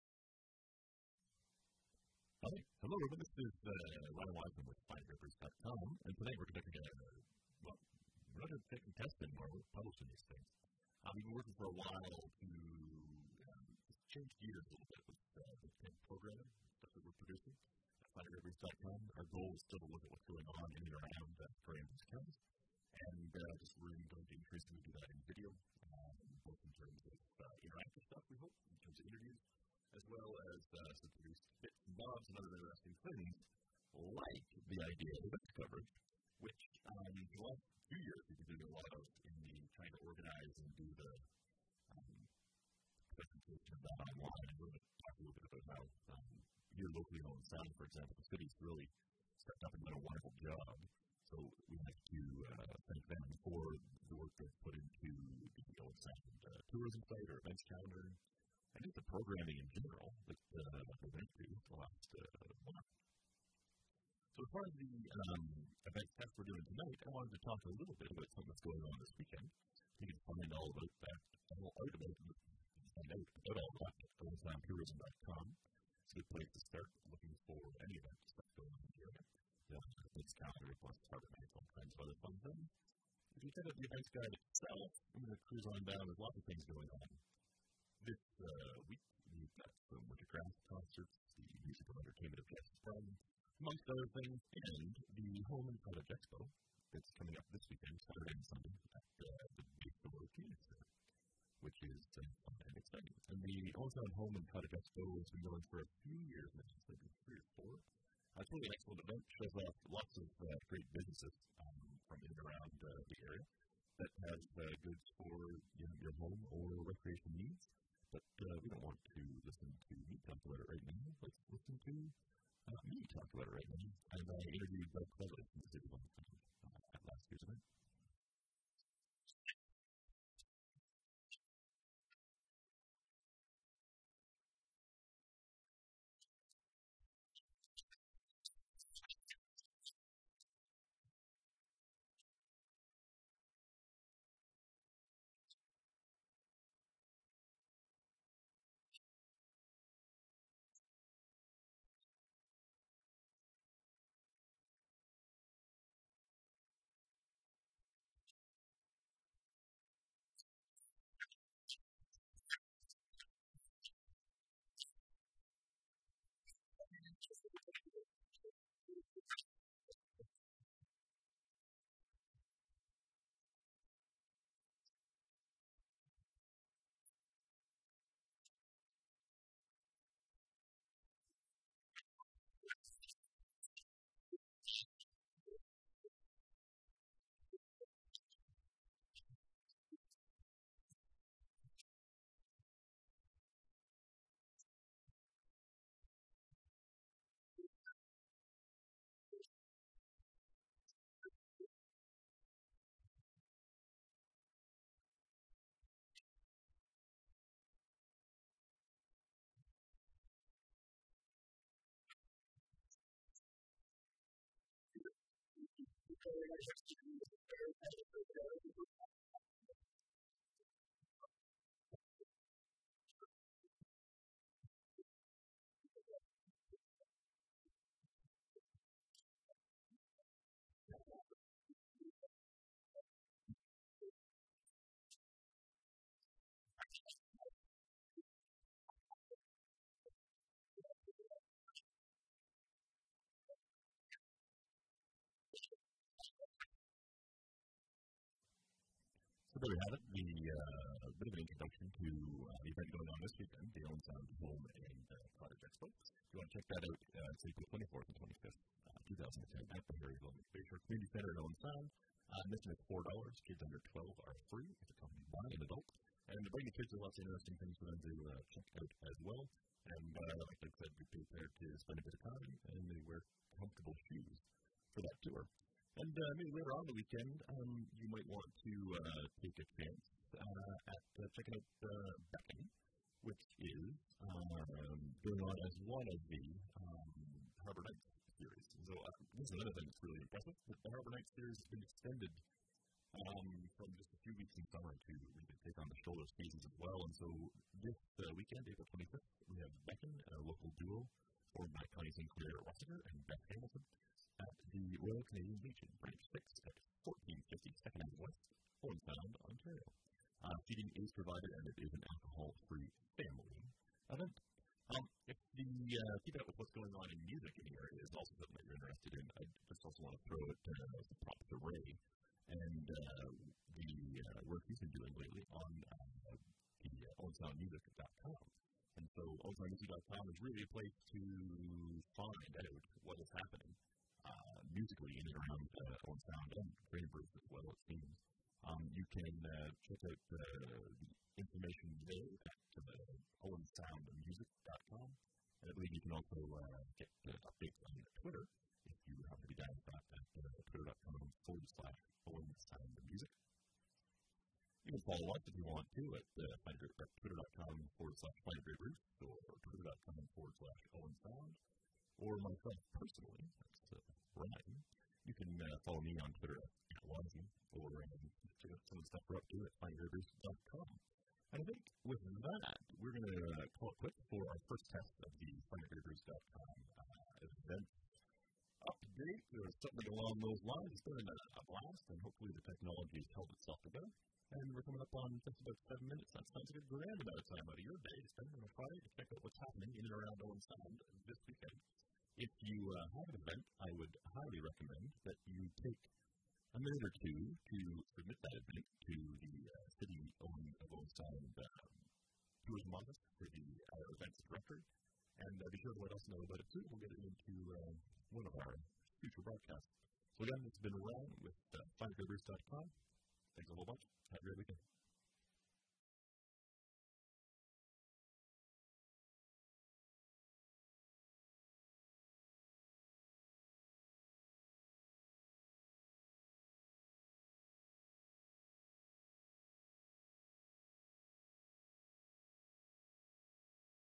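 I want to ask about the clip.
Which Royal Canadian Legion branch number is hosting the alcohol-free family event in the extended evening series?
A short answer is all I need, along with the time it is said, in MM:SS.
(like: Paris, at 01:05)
Branch 6, at 05:06.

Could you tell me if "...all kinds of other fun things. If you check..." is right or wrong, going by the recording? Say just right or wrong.
right.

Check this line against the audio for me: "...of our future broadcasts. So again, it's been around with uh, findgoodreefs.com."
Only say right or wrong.
right.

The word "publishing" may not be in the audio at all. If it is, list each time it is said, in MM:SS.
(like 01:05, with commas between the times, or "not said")
00:09.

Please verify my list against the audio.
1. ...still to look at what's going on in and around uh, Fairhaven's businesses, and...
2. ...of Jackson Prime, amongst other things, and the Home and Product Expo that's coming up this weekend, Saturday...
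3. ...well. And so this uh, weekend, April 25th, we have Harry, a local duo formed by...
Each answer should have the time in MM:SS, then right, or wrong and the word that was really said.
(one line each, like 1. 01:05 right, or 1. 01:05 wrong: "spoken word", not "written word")
1. 00:19 wrong: "counties", not "businesses"
2. 01:32 right
3. 04:56 wrong: "Beckon", not "Harry".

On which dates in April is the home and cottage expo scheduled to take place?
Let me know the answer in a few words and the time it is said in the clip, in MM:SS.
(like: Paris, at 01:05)
April 24th and 25th, at 04:17.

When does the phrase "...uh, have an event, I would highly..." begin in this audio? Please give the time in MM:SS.
06:32.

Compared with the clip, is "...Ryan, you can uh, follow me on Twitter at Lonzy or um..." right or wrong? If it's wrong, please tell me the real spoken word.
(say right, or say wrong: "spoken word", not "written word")
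right.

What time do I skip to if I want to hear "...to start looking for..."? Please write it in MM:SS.
01:16.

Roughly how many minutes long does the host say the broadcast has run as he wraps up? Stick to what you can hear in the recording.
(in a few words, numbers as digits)
7.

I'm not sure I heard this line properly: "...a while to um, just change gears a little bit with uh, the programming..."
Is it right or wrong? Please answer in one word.
right.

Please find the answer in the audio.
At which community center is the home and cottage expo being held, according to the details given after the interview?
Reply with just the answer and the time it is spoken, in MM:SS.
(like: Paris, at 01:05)
Harry Fisher Community Center, at 04:20.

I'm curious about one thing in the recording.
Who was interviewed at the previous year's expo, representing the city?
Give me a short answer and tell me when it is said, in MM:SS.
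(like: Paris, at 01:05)
Doug Cleveland, at 02:04.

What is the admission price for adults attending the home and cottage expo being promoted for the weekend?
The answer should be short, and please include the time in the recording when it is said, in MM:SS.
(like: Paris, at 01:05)
$4, at 04:22.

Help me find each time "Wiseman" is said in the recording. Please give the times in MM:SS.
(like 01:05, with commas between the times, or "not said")
00:04.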